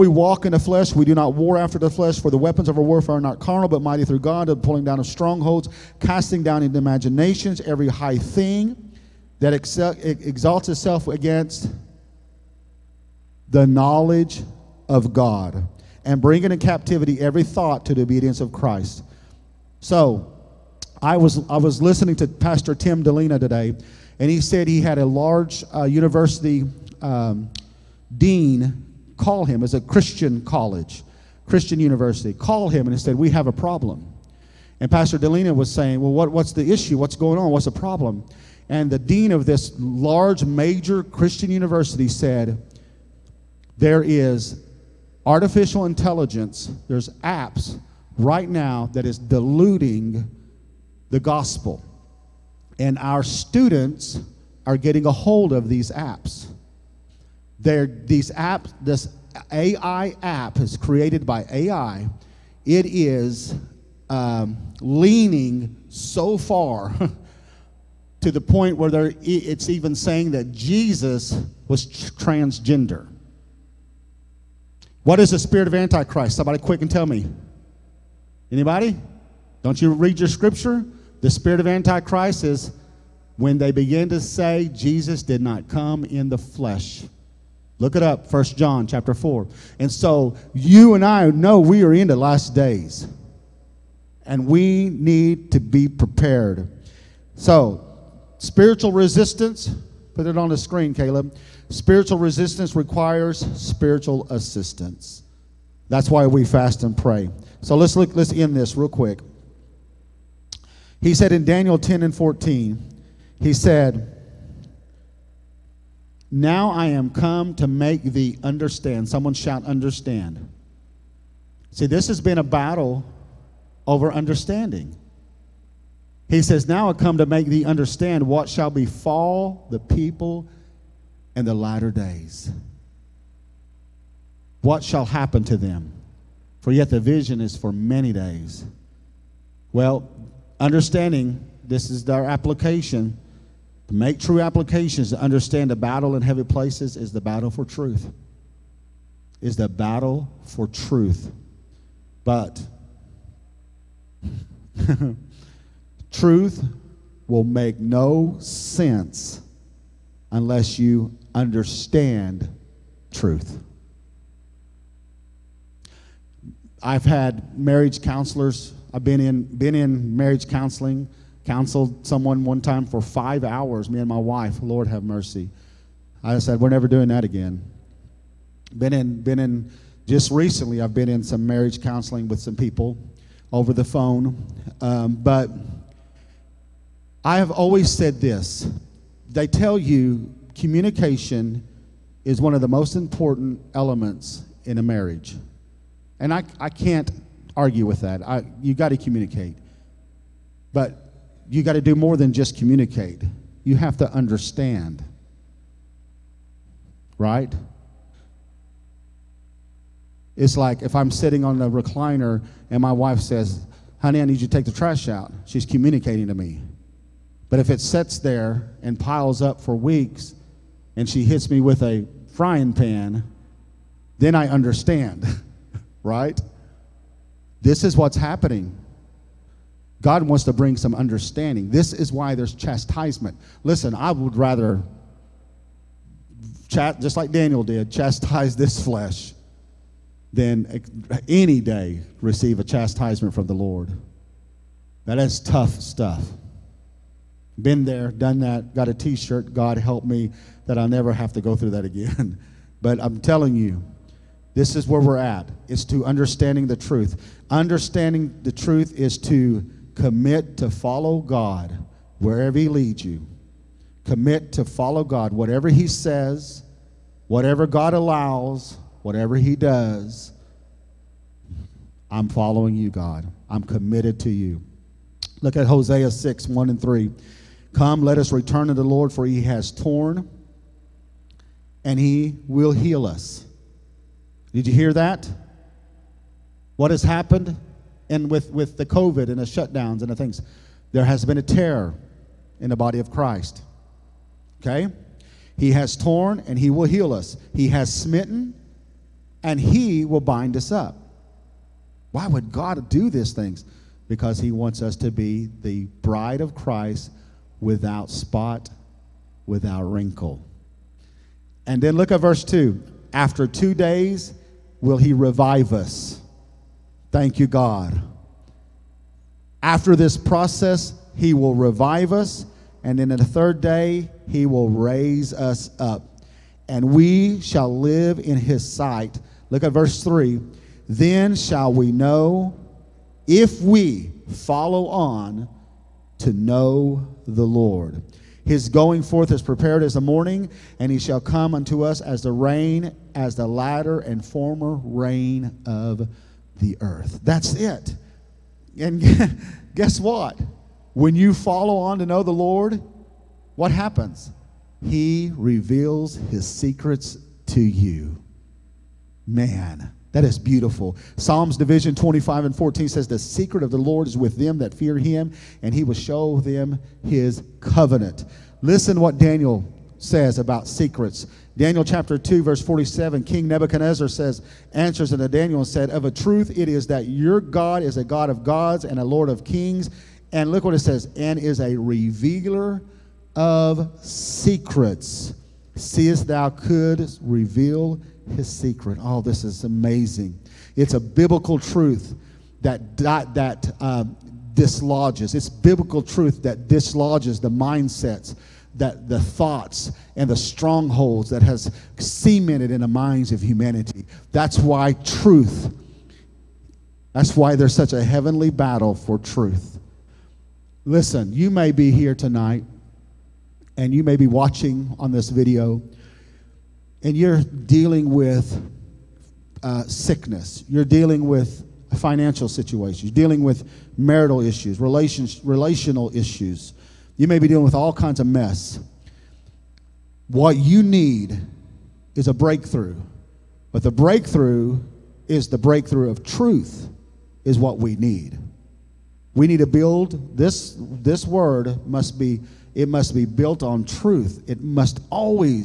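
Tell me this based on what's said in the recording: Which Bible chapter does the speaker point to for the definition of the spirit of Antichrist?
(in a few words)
First John chapter 4.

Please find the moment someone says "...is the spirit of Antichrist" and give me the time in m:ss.
1:15.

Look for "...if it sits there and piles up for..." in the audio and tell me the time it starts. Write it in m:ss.
3:37.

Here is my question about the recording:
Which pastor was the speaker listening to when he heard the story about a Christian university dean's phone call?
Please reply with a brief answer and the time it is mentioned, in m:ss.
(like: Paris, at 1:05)
Tim Dilena, at 0:22.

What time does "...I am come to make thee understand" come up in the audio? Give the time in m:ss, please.
1:56.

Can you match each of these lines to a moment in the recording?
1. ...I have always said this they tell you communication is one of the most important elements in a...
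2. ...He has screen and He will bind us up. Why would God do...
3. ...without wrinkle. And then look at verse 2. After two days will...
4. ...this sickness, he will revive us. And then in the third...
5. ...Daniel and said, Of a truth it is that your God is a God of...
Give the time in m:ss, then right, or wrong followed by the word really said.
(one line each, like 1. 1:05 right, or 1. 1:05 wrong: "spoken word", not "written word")
1. 3:07 right
2. 4:57 wrong: "smitten", not "screen"
3. 5:09 right
4. 5:19 wrong: "process", not "sickness"
5. 6:15 right.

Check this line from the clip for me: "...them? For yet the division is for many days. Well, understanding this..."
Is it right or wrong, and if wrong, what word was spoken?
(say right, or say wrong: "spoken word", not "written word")
wrong: "vision", not "division".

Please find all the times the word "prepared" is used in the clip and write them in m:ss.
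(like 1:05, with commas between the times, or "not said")
1:35, 5:39.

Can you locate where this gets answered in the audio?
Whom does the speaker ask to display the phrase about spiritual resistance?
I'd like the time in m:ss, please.
1:40.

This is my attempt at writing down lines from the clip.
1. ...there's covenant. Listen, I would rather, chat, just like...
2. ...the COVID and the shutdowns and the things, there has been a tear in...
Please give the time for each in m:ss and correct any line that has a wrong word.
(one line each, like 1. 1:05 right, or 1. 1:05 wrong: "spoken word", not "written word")
1. 3:52 wrong: "chastisement", not "covenant"
2. 4:48 right.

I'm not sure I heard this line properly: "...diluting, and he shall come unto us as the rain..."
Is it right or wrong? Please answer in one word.
wrong.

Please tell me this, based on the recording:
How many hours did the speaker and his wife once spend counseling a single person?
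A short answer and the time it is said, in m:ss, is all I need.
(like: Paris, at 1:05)
5, at 2:53.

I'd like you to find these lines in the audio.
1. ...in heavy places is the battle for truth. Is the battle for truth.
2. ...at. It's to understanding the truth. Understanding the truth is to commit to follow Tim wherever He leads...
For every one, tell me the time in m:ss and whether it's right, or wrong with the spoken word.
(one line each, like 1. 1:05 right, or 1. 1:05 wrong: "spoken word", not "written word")
1. 2:26 right
2. 4:15 wrong: "God", not "Tim".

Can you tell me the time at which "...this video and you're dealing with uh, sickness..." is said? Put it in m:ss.
6:55.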